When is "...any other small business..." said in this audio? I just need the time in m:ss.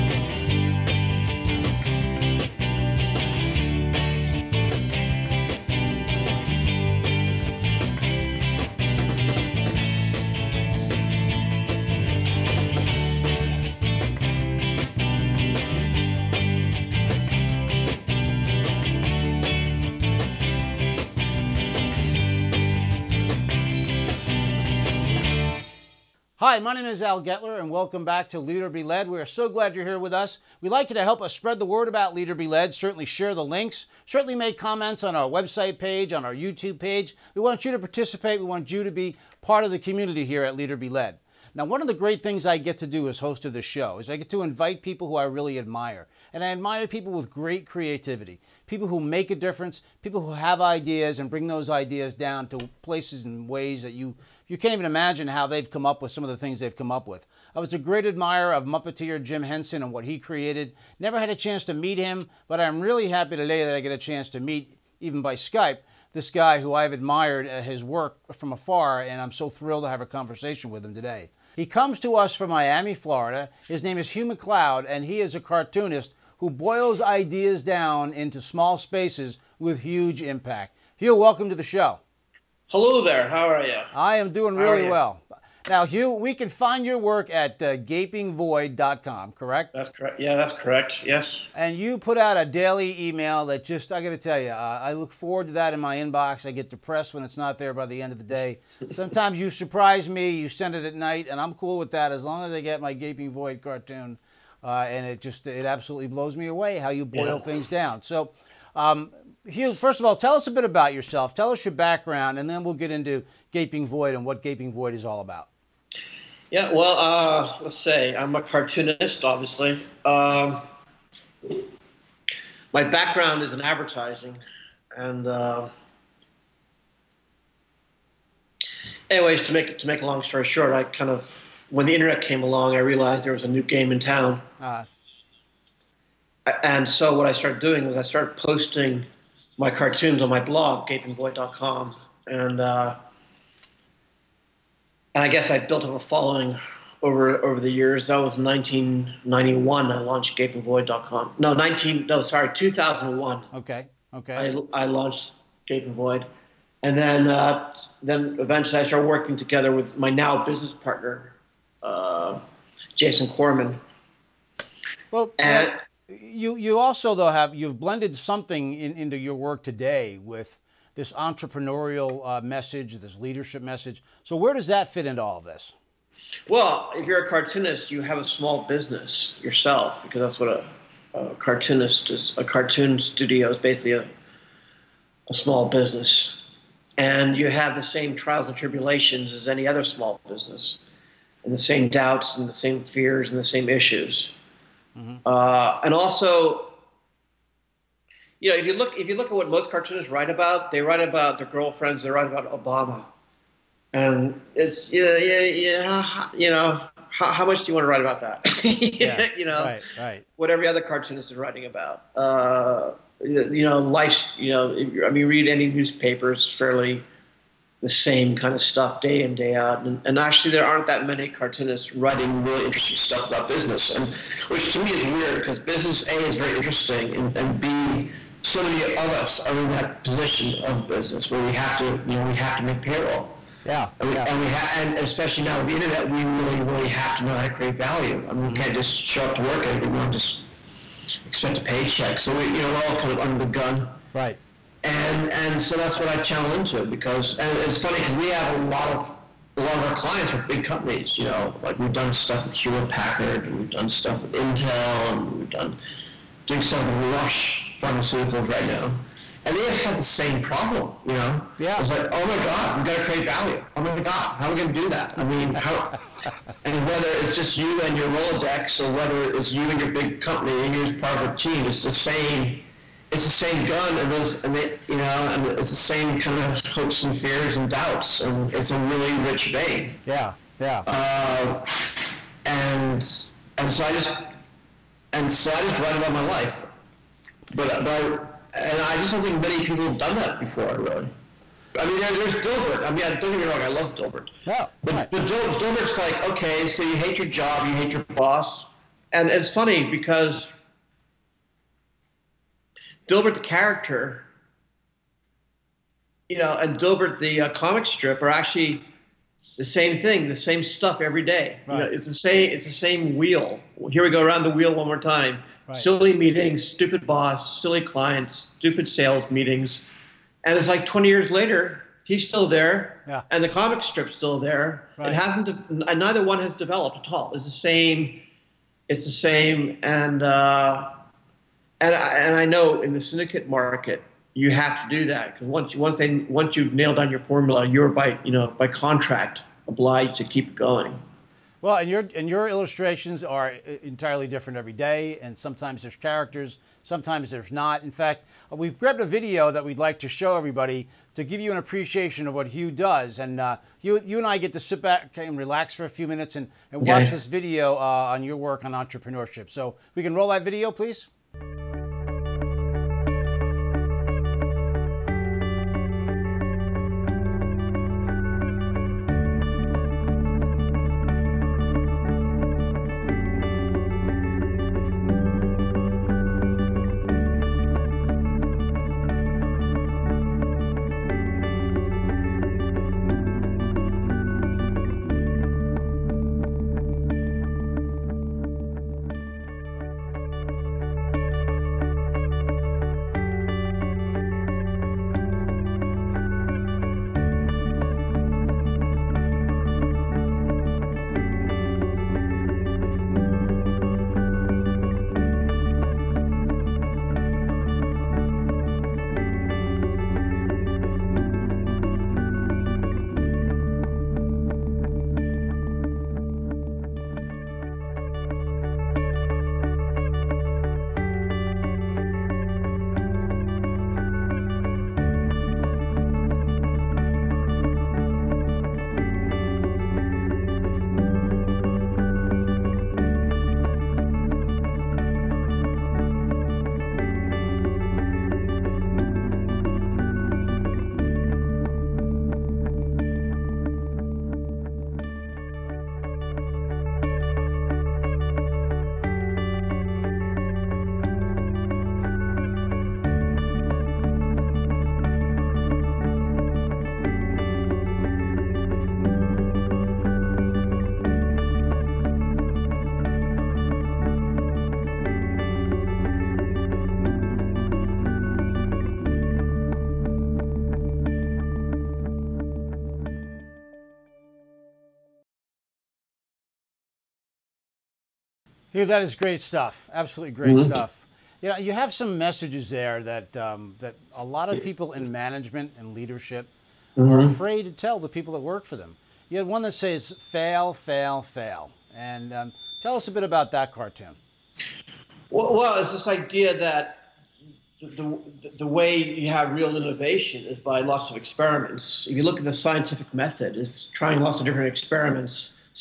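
3:09.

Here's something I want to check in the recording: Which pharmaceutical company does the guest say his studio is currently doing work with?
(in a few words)
Roche.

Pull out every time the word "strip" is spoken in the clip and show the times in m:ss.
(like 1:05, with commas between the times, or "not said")
5:07, 5:23.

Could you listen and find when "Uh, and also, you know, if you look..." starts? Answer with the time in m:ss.
3:15.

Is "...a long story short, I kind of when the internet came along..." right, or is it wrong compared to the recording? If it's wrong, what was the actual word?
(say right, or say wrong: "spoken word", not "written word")
right.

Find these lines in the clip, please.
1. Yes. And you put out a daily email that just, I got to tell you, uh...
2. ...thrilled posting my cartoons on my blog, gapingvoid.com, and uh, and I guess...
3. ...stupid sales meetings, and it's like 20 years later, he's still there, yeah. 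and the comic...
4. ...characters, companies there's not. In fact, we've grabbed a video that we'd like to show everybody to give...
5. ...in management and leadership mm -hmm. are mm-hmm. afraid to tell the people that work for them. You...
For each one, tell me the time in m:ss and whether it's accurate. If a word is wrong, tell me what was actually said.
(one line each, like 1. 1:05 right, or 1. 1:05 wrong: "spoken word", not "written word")
1. 1:31 right
2. 2:18 wrong: "started", not "thrilled"
3. 5:18 right
4. 5:45 wrong: "sometimes", not "companies"
5. 8:04 right.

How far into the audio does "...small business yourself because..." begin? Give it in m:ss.
2:58.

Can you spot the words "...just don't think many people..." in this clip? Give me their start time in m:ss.
4:48.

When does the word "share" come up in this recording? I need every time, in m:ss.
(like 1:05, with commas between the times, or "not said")
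0:33.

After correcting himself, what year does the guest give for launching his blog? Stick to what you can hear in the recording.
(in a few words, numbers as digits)
2001.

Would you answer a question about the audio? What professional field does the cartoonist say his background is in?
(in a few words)
Advertising.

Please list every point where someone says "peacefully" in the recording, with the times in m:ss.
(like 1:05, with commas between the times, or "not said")
not said.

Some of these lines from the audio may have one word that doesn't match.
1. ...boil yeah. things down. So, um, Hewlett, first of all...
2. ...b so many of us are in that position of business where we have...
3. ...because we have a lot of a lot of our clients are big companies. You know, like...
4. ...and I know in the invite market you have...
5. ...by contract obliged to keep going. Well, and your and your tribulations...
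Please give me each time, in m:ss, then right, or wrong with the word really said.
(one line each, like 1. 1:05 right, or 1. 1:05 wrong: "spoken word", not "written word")
1. 1:47 wrong: "Hugh", not "Hewlett"
2. 3:47 right
3. 4:07 right
4. 5:32 wrong: "syndicate", not "invite"
5. 5:38 wrong: "illustrations", not "tribulations".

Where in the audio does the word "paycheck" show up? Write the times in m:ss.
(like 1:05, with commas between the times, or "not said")
4:01.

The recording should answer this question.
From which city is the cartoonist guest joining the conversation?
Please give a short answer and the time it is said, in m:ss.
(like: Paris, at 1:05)
Miami, at 1:12.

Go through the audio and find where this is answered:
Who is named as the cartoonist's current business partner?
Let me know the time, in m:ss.
2:42.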